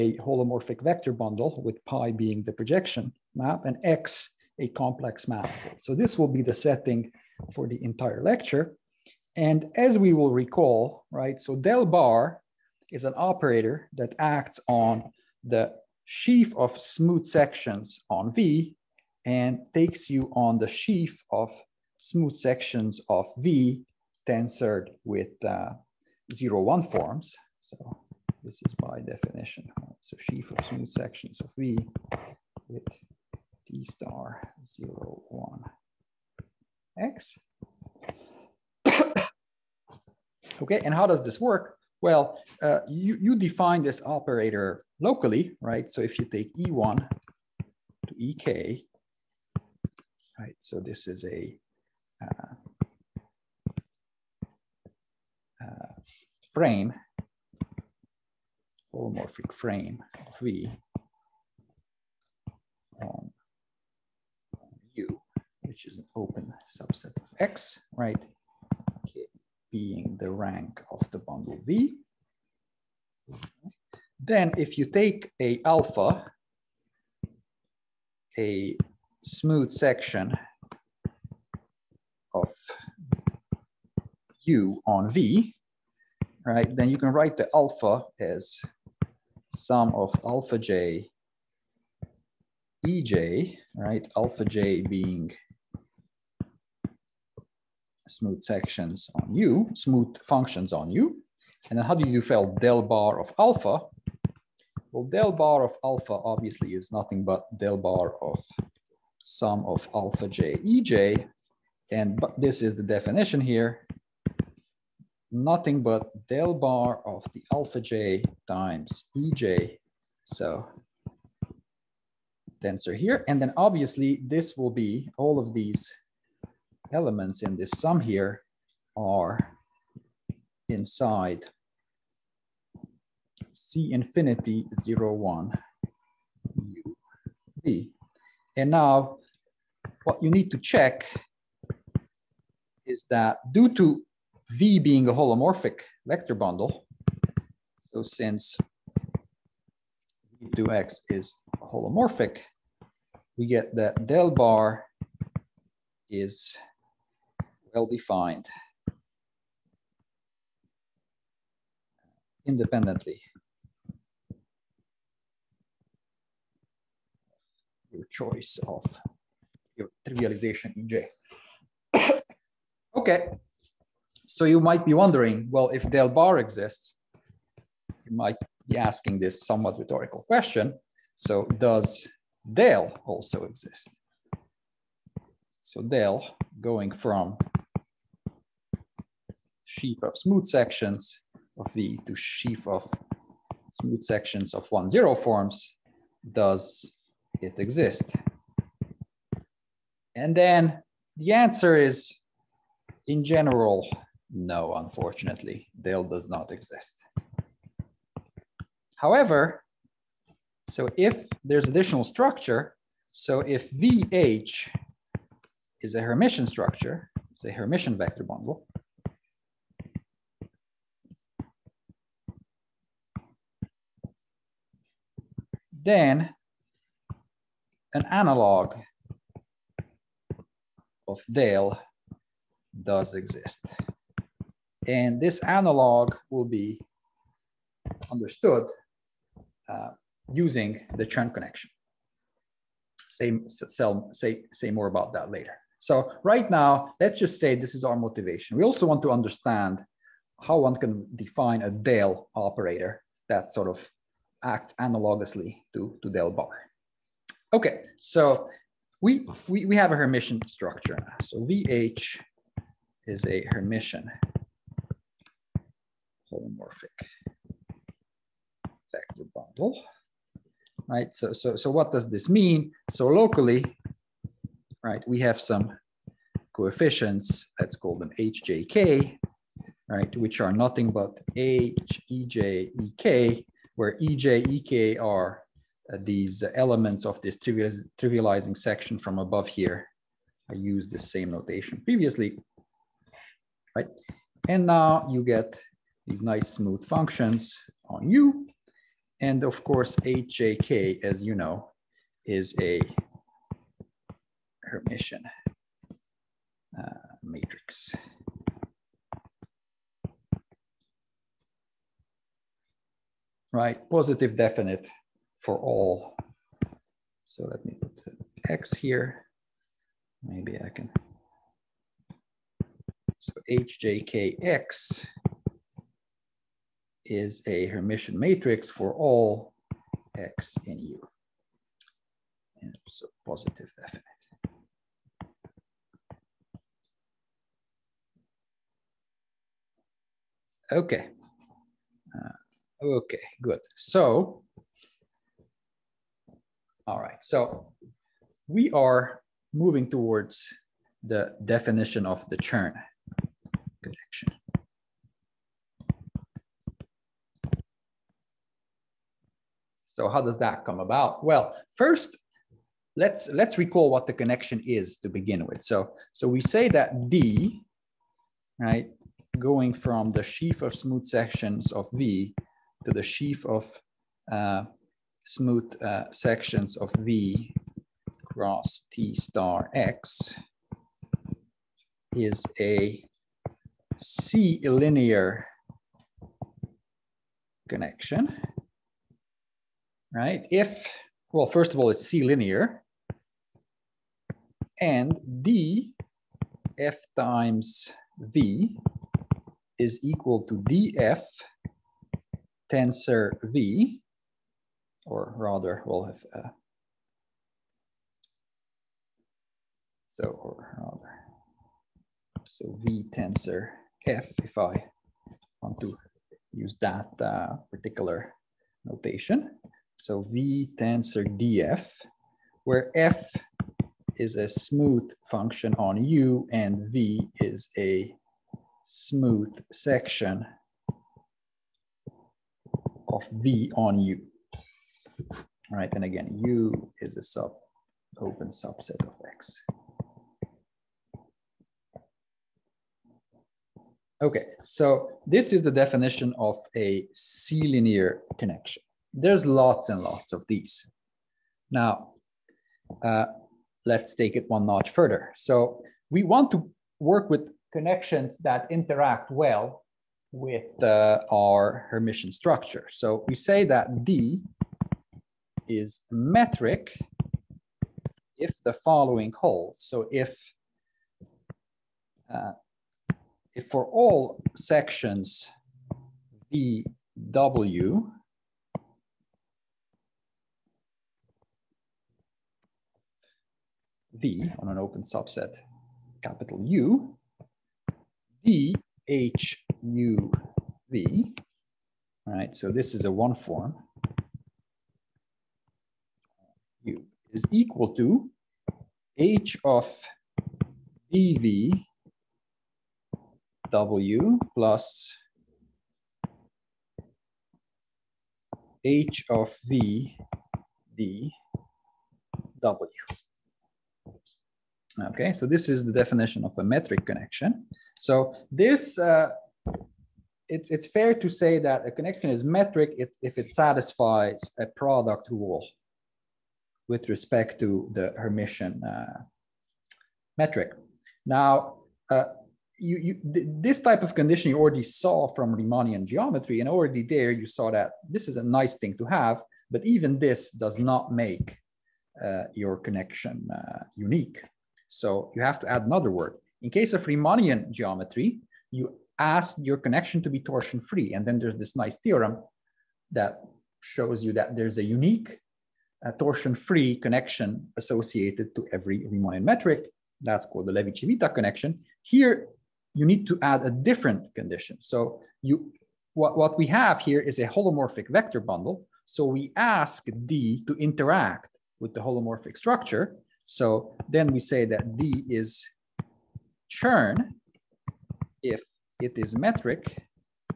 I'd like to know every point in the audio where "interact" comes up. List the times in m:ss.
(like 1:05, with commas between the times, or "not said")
7:38, 9:30.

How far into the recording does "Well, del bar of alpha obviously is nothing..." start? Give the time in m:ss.
1:44.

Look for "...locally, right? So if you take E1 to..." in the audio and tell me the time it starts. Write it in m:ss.
0:44.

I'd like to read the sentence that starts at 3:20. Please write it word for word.
And then the answer is in general, no, unfortunately, del does not exist.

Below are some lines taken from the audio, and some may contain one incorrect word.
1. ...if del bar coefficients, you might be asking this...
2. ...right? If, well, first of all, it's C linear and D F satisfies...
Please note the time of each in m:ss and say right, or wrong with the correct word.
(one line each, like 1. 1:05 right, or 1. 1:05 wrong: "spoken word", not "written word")
1. 2:55 wrong: "exists", not "coefficients"
2. 6:30 wrong: "times", not "satisfies".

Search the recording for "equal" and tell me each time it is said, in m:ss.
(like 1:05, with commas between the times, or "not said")
6:40, 8:17.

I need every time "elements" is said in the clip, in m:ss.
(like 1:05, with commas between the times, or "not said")
2:06, 4:46.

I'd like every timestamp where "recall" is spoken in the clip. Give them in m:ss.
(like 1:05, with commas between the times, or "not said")
0:10, 6:03.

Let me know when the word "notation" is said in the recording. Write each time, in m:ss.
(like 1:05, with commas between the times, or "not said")
4:51, 6:58.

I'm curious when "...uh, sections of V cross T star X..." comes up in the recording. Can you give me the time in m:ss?
6:15.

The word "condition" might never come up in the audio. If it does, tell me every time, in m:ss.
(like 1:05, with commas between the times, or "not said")
8:54, 9:24.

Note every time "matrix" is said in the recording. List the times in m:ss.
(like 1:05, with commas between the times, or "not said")
5:07, 5:28.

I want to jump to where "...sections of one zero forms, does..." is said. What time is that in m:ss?
3:14.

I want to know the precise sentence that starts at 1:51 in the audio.
And but this is the definition here nothing but del bar of the alpha j times ej.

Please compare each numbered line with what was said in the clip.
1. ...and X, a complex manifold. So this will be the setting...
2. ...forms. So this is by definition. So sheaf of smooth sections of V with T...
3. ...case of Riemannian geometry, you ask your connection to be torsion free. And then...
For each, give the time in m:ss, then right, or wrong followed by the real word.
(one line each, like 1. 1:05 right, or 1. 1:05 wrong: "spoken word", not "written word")
1. 0:03 right
2. 0:26 right
3. 9:06 right.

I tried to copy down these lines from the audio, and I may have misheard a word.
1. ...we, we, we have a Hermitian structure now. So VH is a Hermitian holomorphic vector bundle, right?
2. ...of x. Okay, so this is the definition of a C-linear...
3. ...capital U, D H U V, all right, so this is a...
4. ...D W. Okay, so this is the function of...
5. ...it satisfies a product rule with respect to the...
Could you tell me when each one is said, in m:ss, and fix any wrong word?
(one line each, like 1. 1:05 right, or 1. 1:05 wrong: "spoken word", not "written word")
1. 4:19 right
2. 7:19 right
3. 8:06 right
4. 8:30 wrong: "definition", not "function"
5. 8:43 right.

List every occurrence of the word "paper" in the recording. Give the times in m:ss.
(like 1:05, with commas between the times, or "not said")
not said.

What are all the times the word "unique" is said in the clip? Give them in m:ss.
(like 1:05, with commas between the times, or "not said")
9:03, 9:14.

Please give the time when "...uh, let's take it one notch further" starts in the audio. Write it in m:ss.
7:33.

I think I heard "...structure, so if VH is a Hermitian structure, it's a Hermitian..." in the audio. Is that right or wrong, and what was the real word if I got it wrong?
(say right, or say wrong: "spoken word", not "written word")
right.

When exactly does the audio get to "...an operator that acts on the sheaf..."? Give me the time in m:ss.
0:13.